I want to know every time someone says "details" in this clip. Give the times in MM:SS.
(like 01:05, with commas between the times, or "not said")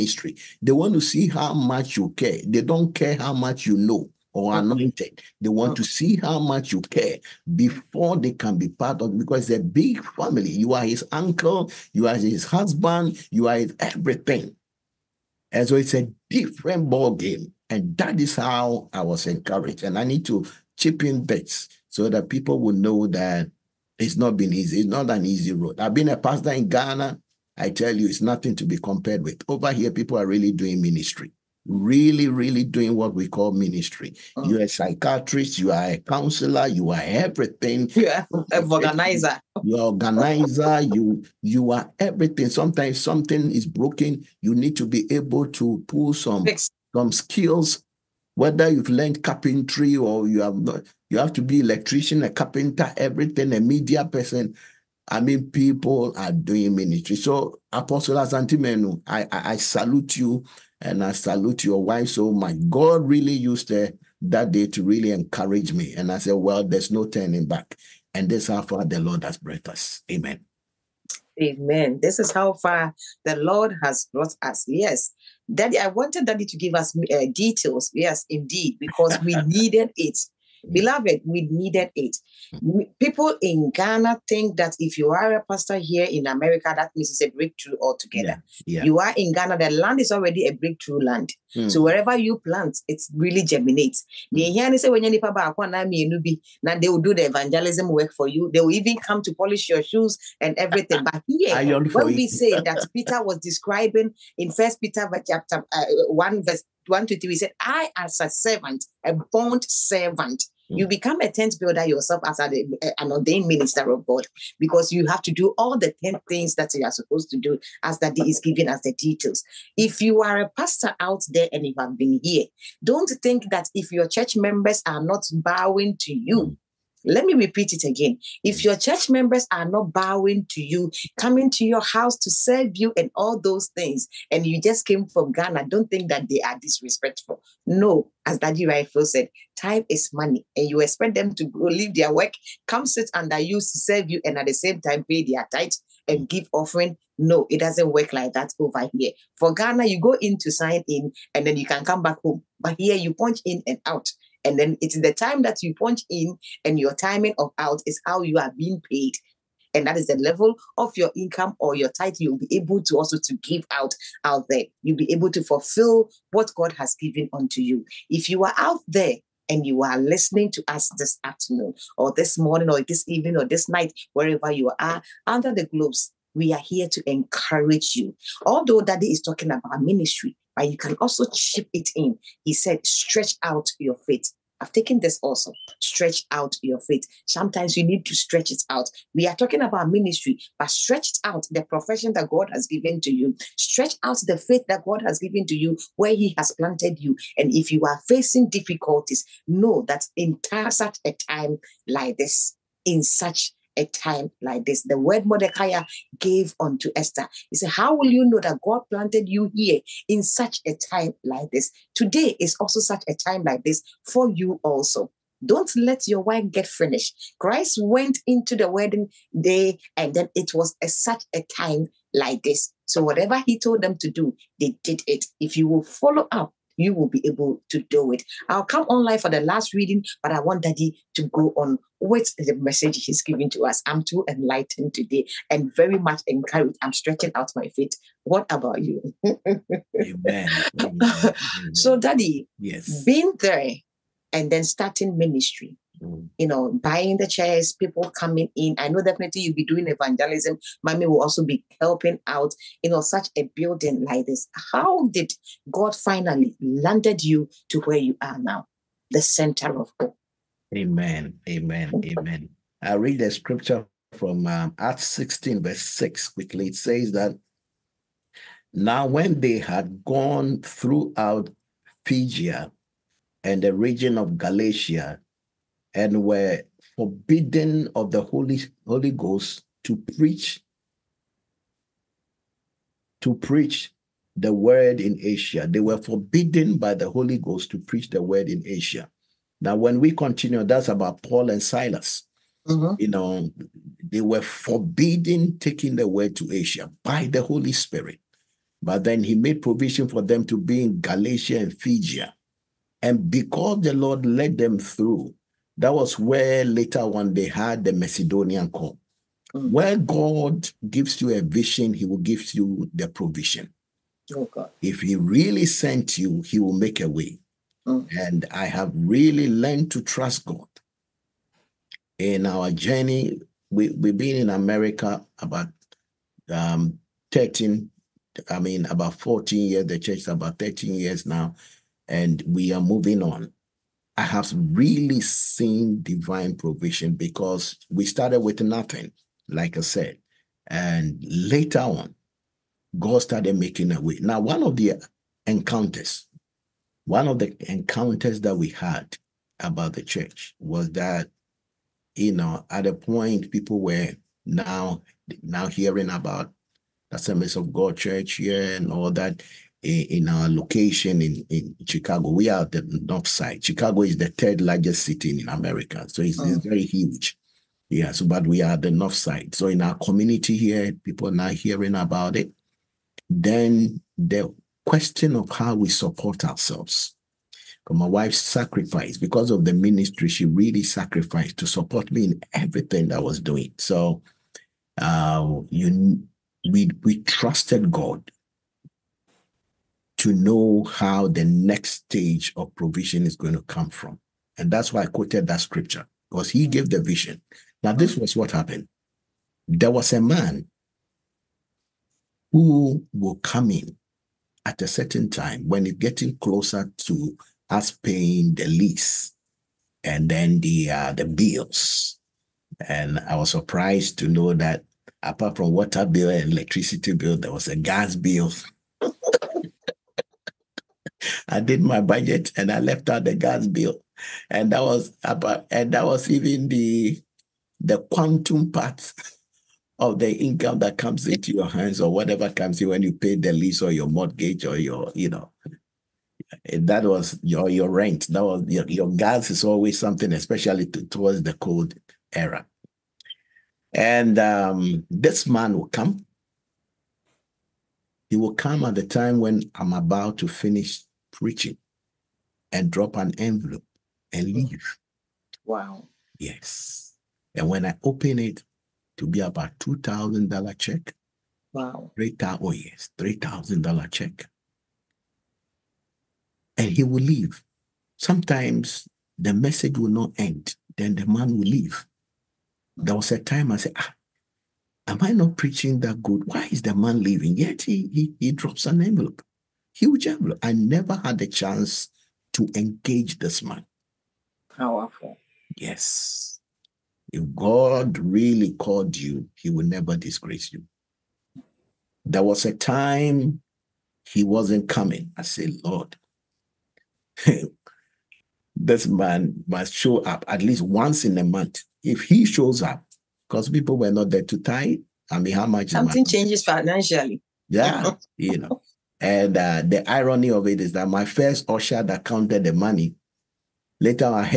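01:17, 01:58.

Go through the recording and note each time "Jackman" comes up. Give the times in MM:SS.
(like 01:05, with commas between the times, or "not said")
08:00.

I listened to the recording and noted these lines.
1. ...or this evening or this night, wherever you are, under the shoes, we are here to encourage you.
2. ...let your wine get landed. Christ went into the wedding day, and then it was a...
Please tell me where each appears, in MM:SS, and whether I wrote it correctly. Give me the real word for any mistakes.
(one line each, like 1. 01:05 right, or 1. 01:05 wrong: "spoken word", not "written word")
1. 02:52 wrong: "globes", not "shoes"
2. 03:35 wrong: "finished", not "landed".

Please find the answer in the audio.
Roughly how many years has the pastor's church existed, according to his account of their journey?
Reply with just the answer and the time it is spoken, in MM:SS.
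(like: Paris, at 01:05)
13 years, at 05:30.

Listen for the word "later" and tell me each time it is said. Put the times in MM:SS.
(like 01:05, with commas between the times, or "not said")
05:06, 05:41, 08:33.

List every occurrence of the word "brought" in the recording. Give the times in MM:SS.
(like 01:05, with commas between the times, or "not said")
01:09, 01:14.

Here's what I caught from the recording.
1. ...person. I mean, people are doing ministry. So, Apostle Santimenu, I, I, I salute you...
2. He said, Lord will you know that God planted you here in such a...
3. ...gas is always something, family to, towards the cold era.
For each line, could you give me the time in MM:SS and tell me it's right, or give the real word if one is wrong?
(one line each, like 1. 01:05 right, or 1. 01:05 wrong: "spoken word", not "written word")
1. 00:54 right
2. 03:27 wrong: "How", not "Lord"
3. 07:19 wrong: "especially", not "family".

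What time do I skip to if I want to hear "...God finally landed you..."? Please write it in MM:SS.
04:15.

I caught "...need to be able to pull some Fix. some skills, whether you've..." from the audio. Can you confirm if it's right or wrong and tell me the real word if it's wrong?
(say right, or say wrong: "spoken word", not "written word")
right.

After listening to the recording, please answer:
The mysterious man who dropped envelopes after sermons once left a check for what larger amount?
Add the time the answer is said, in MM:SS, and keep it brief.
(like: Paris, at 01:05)
$3,000, at 07:43.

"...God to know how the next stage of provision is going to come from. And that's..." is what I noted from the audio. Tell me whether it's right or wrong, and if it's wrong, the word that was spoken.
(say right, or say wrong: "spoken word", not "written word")
right.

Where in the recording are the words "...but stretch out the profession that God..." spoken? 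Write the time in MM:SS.
03:10.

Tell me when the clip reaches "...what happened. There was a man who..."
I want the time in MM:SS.
06:38.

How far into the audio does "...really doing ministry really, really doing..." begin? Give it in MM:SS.
00:30.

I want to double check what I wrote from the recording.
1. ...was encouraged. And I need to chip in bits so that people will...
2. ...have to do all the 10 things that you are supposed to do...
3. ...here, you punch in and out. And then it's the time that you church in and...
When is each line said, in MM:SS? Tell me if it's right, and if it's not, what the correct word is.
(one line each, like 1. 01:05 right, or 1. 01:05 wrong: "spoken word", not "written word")
1. 00:18 right
2. 01:55 right
3. 02:32 wrong: "punch", not "church".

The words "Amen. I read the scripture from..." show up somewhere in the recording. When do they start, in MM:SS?
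04:22.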